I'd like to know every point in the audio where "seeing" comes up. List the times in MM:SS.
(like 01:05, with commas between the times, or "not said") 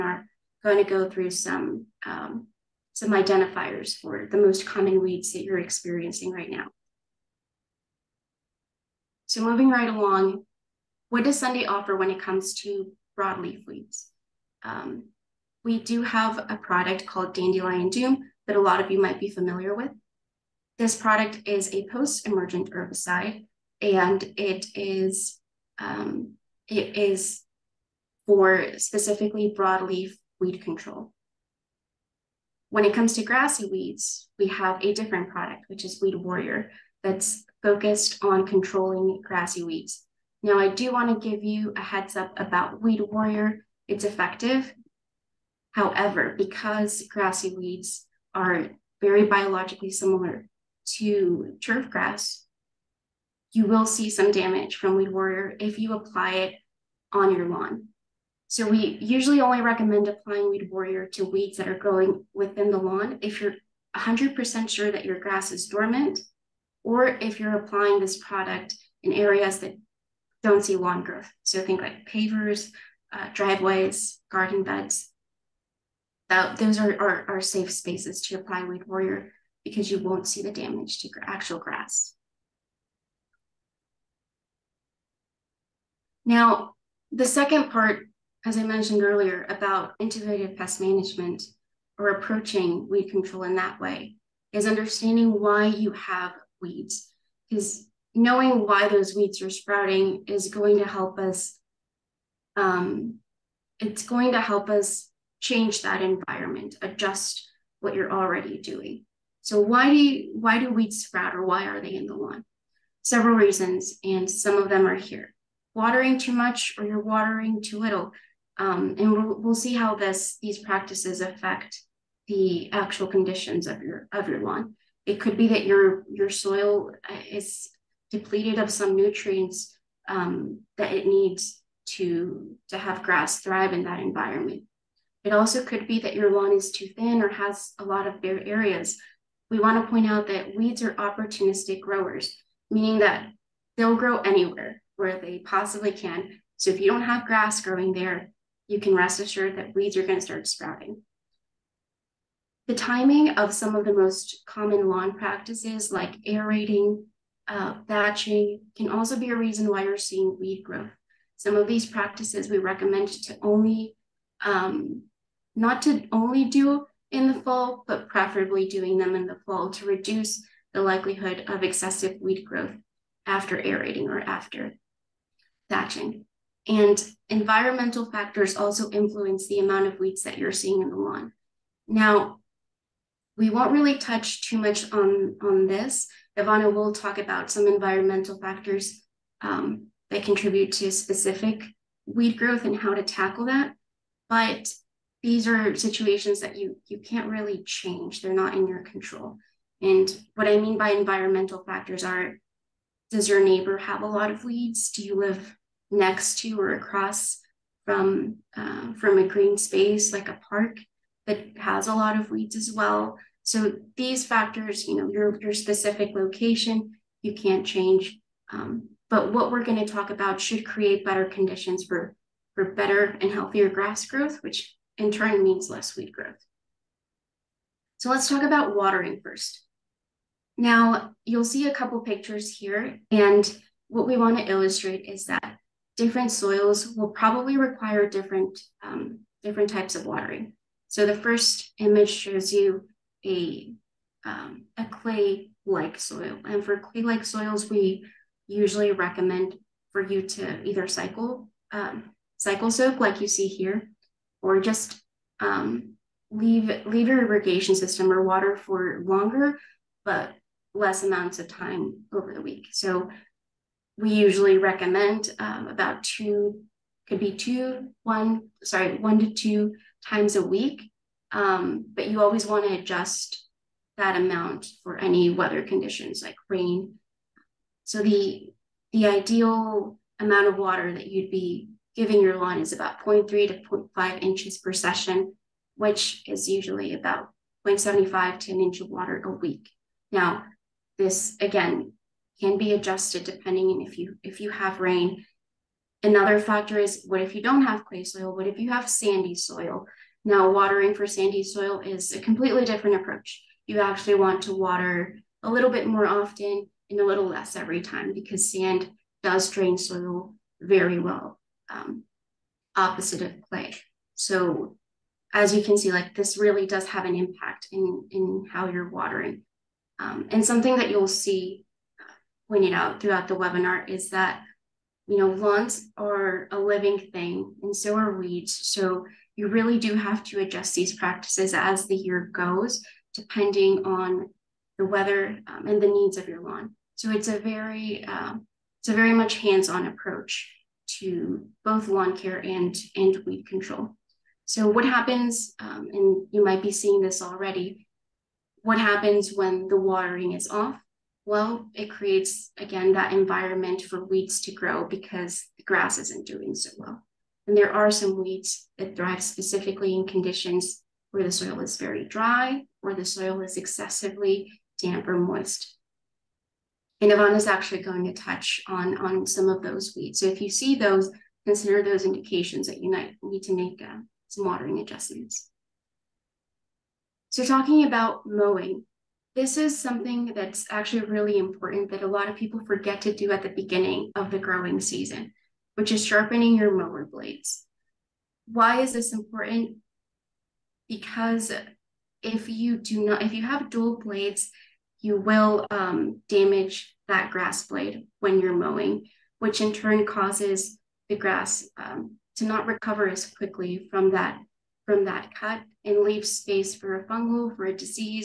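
02:39, 03:00, 05:46.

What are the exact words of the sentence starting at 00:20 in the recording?
This product is a post-emergent herbicide, and it is um, it is for specifically broadleaf weed control.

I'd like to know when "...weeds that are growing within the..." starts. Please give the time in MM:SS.
01:01.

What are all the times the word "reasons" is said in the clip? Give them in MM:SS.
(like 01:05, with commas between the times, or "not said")
01:53, 02:39.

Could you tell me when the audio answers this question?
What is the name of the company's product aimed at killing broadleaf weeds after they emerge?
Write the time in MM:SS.
00:17.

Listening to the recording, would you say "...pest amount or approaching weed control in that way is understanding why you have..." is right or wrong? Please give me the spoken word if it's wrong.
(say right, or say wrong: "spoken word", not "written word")
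wrong: "management", not "amount".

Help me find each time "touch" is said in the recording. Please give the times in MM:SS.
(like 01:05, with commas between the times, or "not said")
03:03, 06:08.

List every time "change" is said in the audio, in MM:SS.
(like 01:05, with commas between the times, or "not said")
01:45, 03:17, 03:37.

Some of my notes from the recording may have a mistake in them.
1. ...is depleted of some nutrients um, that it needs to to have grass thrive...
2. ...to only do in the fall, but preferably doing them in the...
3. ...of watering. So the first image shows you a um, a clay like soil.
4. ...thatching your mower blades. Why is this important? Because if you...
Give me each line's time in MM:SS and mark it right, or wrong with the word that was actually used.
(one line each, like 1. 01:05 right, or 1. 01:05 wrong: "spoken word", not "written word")
1. 02:07 right
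2. 02:45 right
3. 03:59 right
4. 06:26 wrong: "sharpening", not "thatching".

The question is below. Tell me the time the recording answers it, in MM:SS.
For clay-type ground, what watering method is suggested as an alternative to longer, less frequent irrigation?
04:12.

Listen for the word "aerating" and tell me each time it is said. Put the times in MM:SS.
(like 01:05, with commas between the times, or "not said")
02:36, 02:53.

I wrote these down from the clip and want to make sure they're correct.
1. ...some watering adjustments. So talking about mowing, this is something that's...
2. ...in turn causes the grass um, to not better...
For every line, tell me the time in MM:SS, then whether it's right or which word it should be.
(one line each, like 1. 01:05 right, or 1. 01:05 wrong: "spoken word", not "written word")
1. 06:14 right
2. 06:39 wrong: "recover", not "better".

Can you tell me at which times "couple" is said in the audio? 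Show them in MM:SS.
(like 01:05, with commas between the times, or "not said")
03:51.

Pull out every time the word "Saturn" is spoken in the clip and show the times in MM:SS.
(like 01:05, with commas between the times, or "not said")
not said.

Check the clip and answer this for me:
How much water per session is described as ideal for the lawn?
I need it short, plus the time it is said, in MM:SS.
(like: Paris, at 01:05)
0.3 to 0.5 inches, at 04:43.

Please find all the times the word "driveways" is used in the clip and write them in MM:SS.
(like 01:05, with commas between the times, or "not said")
01:13.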